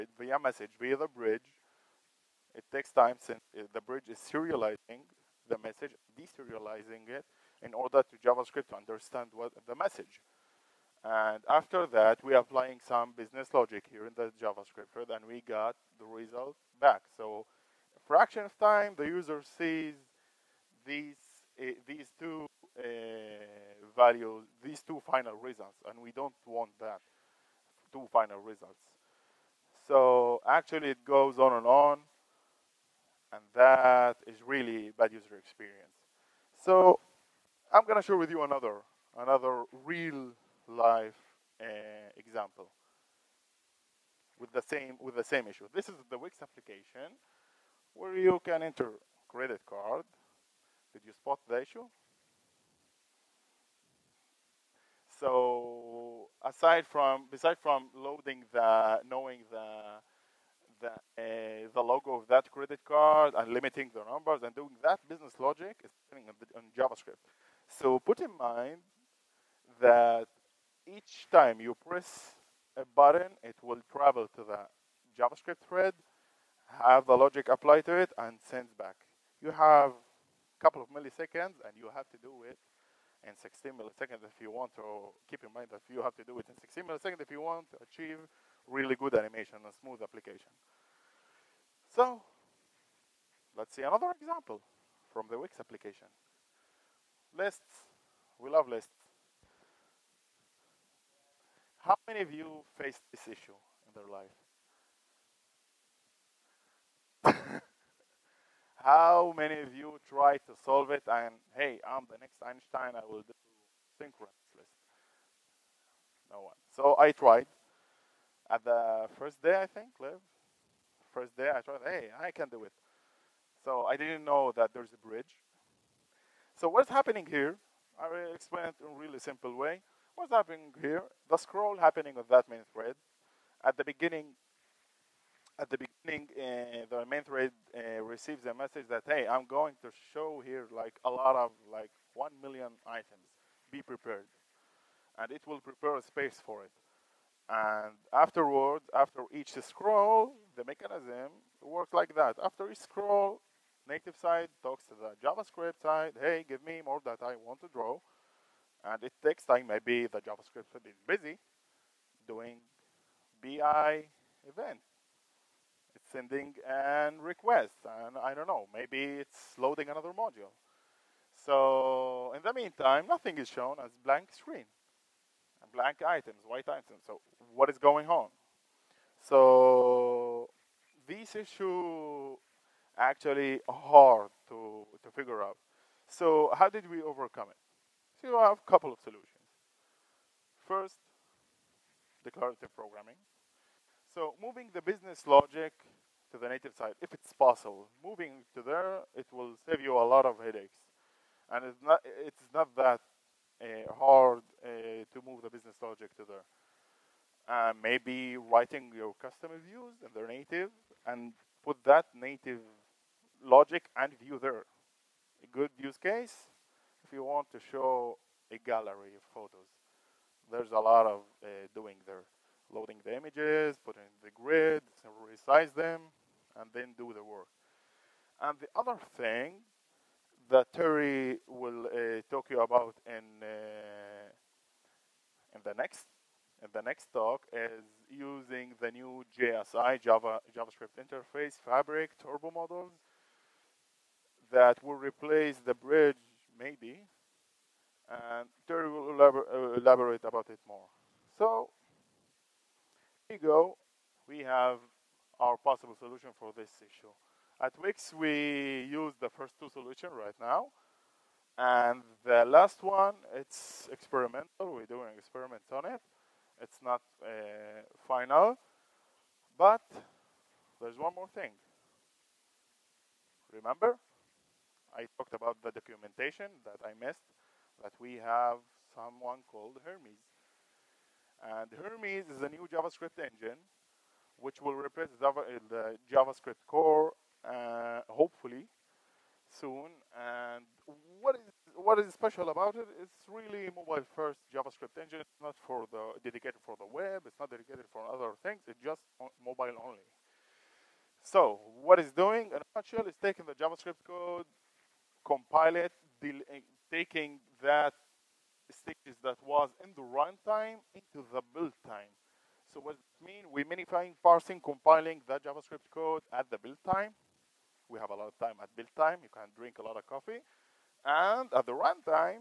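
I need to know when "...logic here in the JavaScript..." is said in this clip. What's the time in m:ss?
0:13.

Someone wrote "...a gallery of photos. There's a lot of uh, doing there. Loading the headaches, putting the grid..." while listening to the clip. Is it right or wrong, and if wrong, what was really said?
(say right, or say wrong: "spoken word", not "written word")
wrong: "images", not "headaches".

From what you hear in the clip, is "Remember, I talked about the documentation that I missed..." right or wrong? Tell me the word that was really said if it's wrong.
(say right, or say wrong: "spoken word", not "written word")
right.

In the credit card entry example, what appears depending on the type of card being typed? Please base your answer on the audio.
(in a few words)
the logo.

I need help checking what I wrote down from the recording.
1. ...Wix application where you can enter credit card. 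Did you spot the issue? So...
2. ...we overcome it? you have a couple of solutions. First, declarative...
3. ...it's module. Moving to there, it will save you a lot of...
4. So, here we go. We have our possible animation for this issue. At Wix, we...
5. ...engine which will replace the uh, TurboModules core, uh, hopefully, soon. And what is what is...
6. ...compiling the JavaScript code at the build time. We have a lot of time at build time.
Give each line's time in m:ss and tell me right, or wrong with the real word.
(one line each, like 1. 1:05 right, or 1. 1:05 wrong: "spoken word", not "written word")
1. 0:46 right
2. 3:06 right
3. 3:17 wrong: "possible", not "module"
4. 4:11 wrong: "solution", not "animation"
5. 4:43 wrong: "JavaScript", not "TurboModules"
6. 5:14 right.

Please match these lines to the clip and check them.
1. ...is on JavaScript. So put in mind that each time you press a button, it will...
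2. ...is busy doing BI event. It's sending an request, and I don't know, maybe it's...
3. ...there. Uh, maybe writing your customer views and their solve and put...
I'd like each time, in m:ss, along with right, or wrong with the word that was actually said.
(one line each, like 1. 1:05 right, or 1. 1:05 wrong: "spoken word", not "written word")
1. 1:05 right
2. 2:40 right
3. 3:26 wrong: "native", not "solve".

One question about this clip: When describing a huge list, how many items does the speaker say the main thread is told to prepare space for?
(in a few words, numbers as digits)
one million.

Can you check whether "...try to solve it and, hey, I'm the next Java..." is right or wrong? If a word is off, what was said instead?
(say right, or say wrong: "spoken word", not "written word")
wrong: "Einstein", not "Java".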